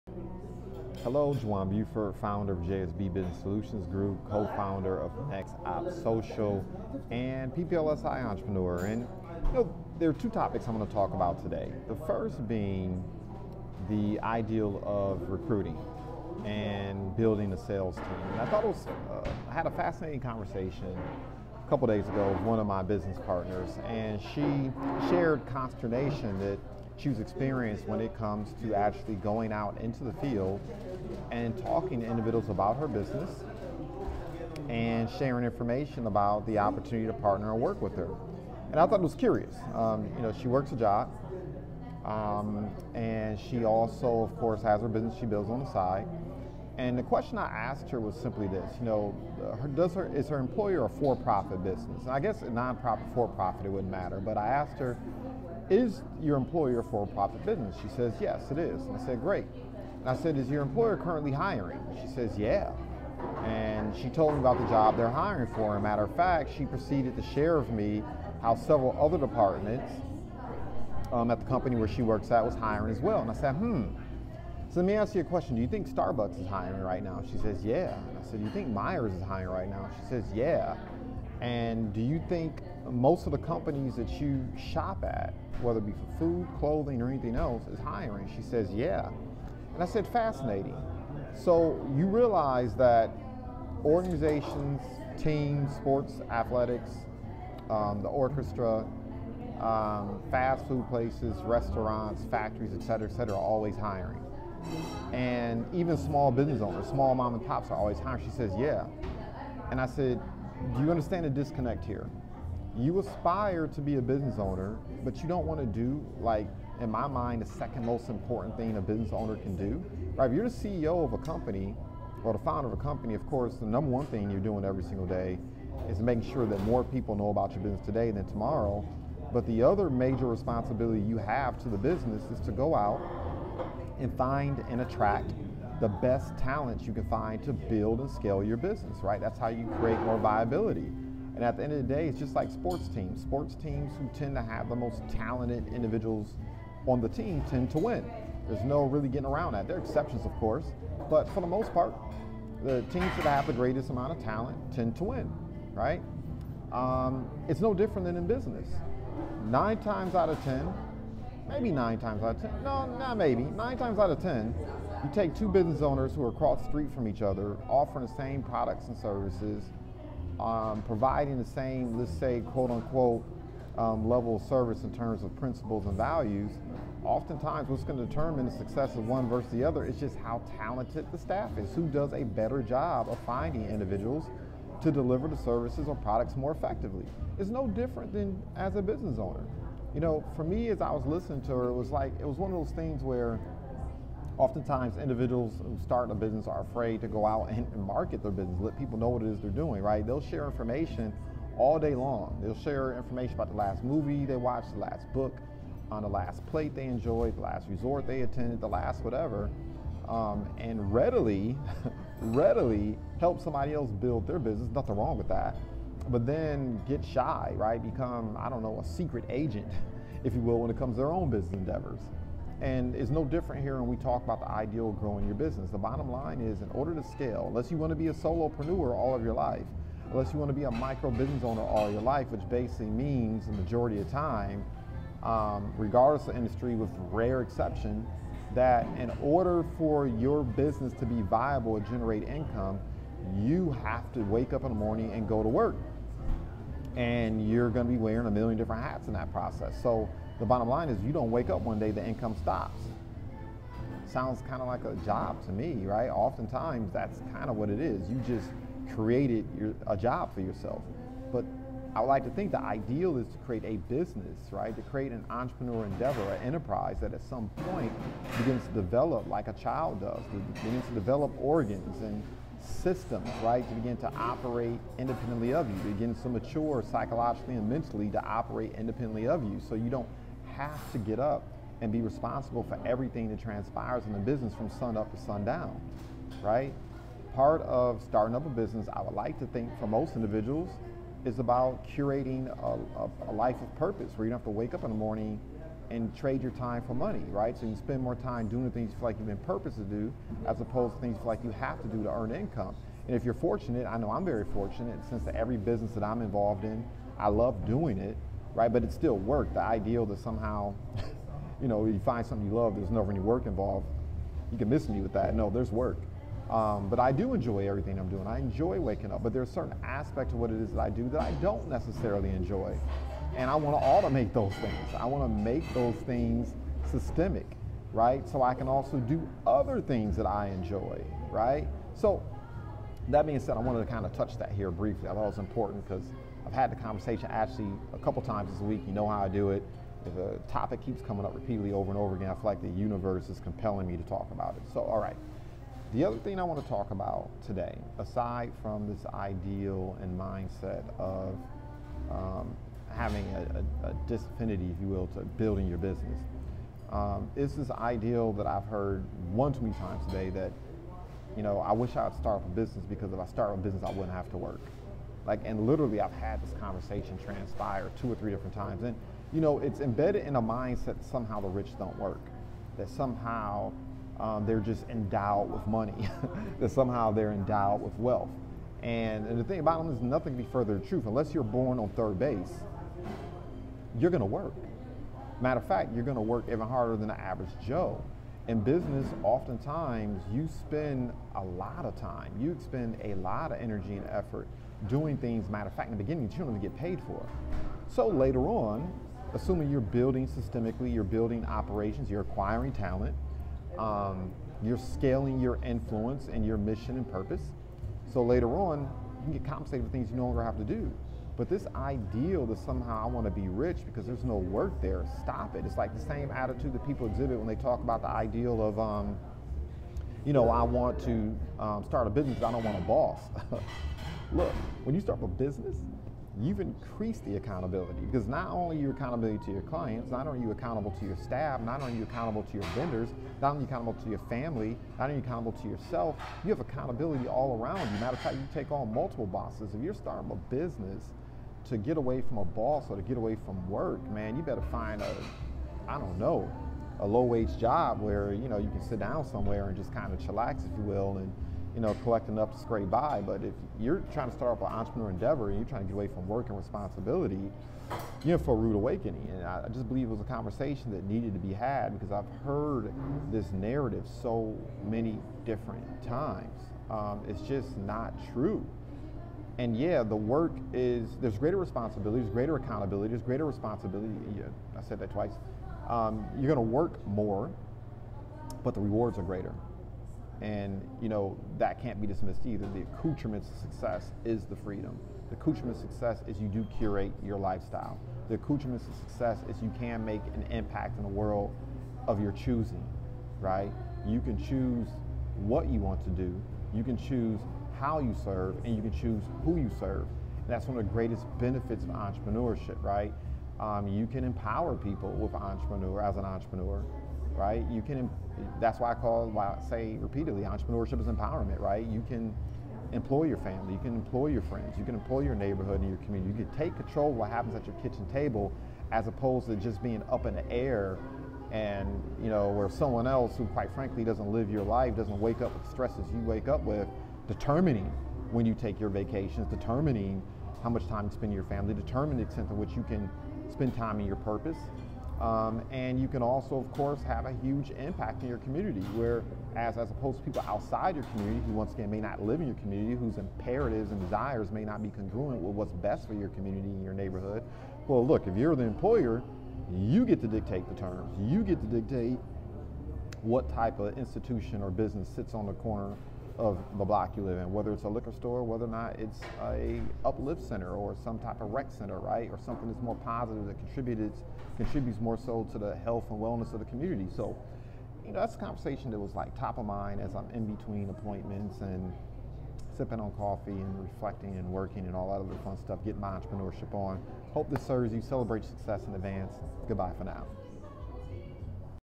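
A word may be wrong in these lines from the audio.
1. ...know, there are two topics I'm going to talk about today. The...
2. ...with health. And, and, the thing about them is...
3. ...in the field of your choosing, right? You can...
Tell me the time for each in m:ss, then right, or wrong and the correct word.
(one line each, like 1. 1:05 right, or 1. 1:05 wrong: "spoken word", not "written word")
1. 0:09 right
2. 6:17 wrong: "wealth", not "health"
3. 8:10 wrong: "world", not "field".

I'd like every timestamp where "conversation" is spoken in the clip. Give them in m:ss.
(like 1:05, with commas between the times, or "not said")
0:20, 5:36, 6:06, 7:40, 9:28.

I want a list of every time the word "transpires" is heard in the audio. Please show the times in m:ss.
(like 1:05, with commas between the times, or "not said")
4:43, 6:07.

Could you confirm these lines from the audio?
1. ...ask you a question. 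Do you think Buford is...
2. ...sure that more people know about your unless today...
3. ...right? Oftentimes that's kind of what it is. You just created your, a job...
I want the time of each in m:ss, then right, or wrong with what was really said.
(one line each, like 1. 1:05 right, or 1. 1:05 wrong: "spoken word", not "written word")
1. 1:14 wrong: "Starbucks", not "Buford"
2. 2:06 wrong: "business", not "unless"
3. 4:15 right.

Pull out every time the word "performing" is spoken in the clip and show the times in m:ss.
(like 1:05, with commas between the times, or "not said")
not said.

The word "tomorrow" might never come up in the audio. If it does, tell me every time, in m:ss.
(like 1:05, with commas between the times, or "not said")
2:08.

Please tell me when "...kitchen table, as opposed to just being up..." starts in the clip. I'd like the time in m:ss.
8:37.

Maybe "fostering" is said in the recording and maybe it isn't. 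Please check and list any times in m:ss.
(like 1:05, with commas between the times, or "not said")
not said.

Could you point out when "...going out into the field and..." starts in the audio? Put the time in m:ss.
0:29.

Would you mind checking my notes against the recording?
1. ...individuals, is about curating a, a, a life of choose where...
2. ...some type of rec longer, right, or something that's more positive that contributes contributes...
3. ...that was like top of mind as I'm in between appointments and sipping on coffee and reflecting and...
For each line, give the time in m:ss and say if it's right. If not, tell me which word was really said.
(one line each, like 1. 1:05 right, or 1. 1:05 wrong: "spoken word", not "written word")
1. 4:50 wrong: "purpose", not "choose"
2. 9:21 wrong: "center", not "longer"
3. 9:28 right.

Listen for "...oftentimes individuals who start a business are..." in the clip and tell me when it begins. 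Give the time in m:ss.
3:14.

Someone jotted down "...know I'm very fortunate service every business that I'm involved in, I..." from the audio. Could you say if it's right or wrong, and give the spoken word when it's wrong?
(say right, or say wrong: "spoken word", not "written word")
wrong: "since", not "service".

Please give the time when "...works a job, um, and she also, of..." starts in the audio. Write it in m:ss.
0:40.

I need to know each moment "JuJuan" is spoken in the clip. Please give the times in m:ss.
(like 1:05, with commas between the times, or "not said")
0:01.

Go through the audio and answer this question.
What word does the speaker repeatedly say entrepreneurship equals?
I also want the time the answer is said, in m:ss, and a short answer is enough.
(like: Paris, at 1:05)
empowerment, at 8:31.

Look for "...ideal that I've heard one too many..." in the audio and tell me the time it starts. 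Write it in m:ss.
5:57.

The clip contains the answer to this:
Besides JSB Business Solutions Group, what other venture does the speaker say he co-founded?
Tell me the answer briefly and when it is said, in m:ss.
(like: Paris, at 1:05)
Next Op Social, at 0:05.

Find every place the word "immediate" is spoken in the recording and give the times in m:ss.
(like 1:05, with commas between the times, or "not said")
not said.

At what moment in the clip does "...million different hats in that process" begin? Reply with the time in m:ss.
4:08.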